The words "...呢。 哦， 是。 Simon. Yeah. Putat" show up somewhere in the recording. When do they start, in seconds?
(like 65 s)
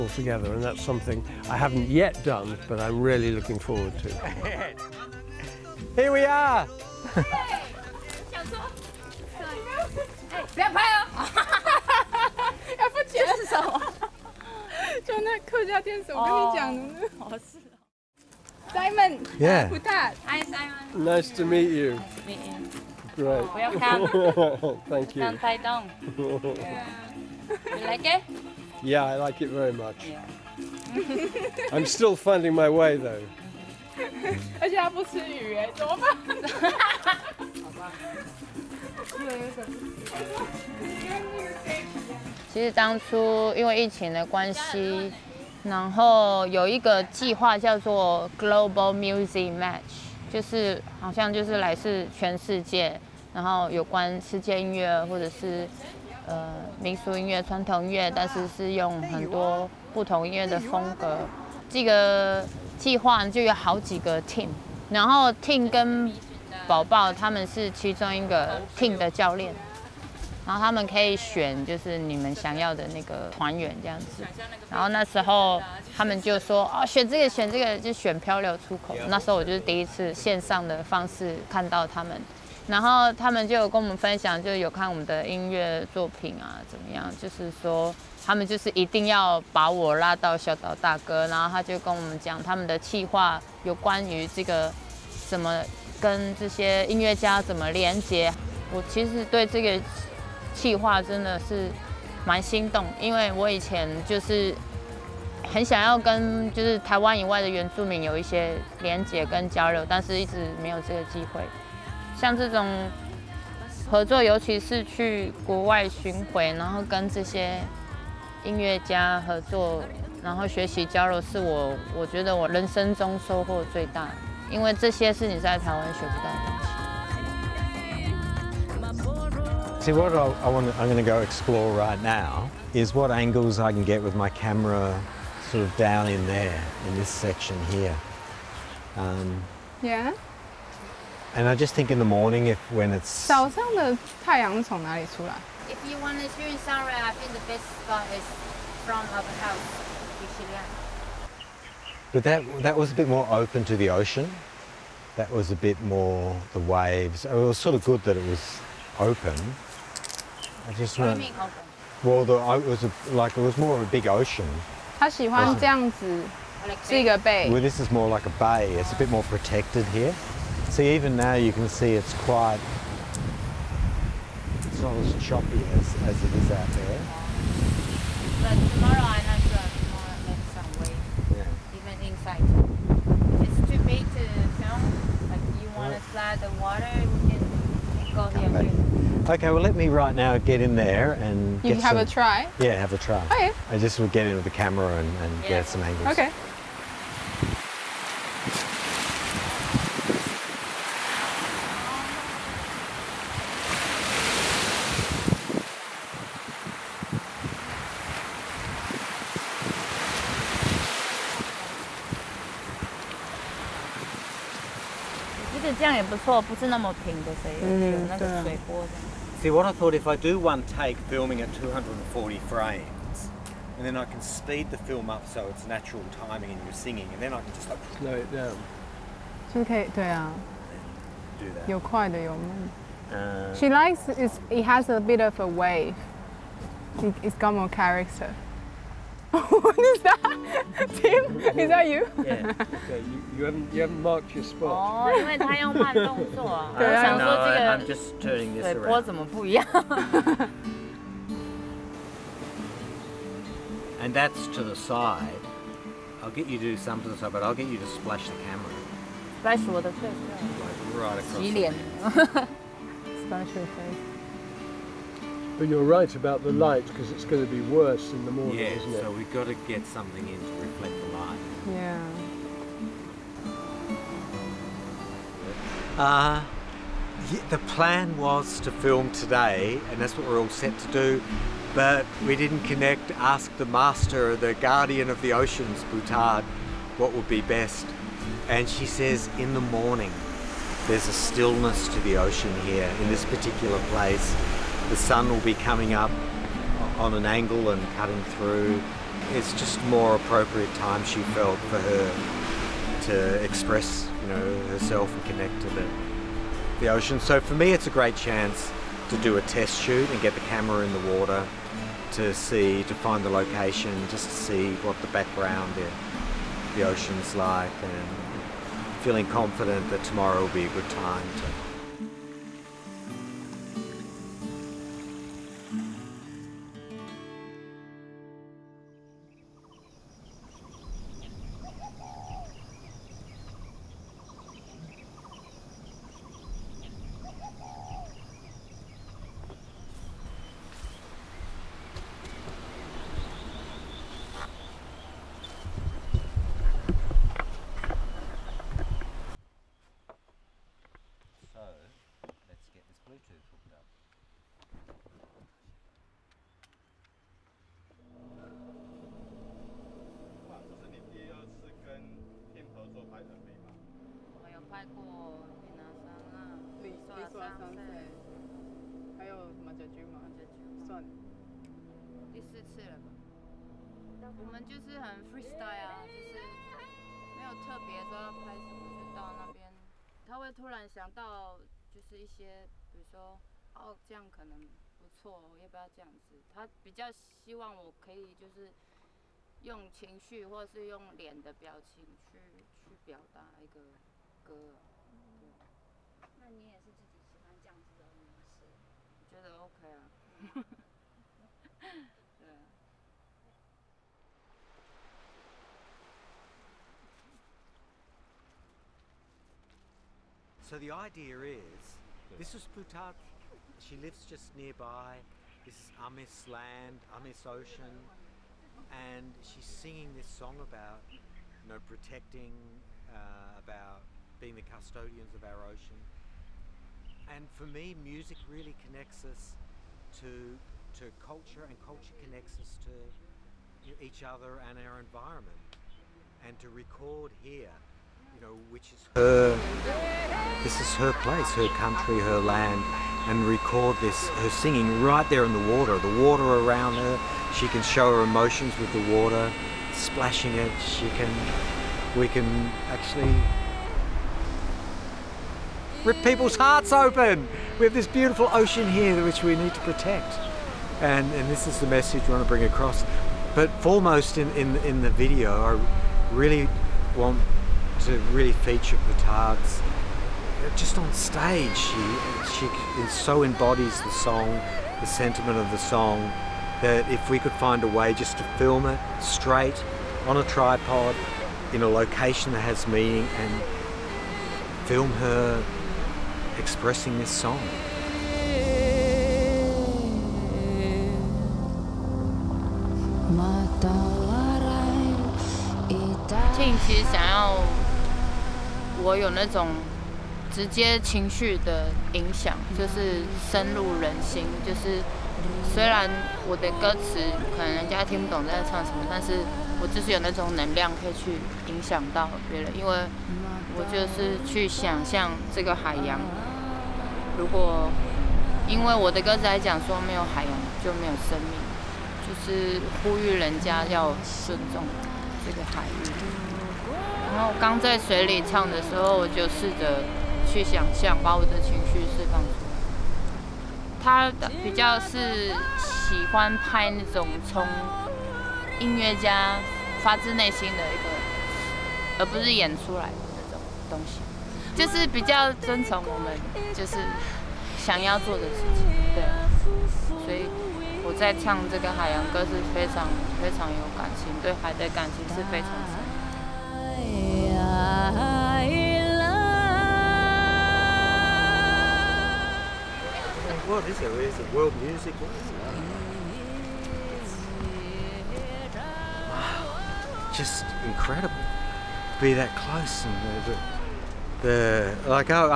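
16 s.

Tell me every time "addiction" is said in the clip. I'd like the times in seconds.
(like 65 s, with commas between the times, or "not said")
not said.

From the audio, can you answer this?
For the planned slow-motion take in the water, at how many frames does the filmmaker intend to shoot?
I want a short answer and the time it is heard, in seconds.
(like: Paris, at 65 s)
240, at 221 s.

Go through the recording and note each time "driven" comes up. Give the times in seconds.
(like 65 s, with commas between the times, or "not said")
not said.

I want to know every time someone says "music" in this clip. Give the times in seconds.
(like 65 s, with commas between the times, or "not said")
48 s, 427 s, 564 s.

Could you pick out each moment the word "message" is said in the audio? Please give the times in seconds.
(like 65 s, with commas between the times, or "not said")
461 s.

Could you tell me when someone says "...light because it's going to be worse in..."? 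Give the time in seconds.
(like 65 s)
266 s.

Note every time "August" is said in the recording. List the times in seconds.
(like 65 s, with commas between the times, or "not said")
not said.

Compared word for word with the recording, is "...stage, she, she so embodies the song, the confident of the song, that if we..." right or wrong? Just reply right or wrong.
wrong.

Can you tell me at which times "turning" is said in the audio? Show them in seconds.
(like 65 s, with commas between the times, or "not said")
248 s.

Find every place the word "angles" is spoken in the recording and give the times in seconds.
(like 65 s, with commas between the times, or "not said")
133 s, 195 s, 297 s.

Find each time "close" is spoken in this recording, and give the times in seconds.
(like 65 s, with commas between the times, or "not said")
572 s.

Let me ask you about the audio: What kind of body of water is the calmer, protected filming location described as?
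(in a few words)
a bay.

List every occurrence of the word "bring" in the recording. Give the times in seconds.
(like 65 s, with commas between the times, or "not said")
462 s.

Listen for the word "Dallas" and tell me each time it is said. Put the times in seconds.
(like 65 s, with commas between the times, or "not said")
not said.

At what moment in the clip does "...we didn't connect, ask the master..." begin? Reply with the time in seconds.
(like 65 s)
282 s.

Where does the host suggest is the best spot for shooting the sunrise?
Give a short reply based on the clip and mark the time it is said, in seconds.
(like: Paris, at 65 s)
our house, at 149 s.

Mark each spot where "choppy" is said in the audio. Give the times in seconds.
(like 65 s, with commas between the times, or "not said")
175 s.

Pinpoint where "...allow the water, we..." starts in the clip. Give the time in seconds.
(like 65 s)
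186 s.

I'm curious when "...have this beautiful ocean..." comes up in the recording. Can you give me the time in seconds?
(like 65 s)
457 s.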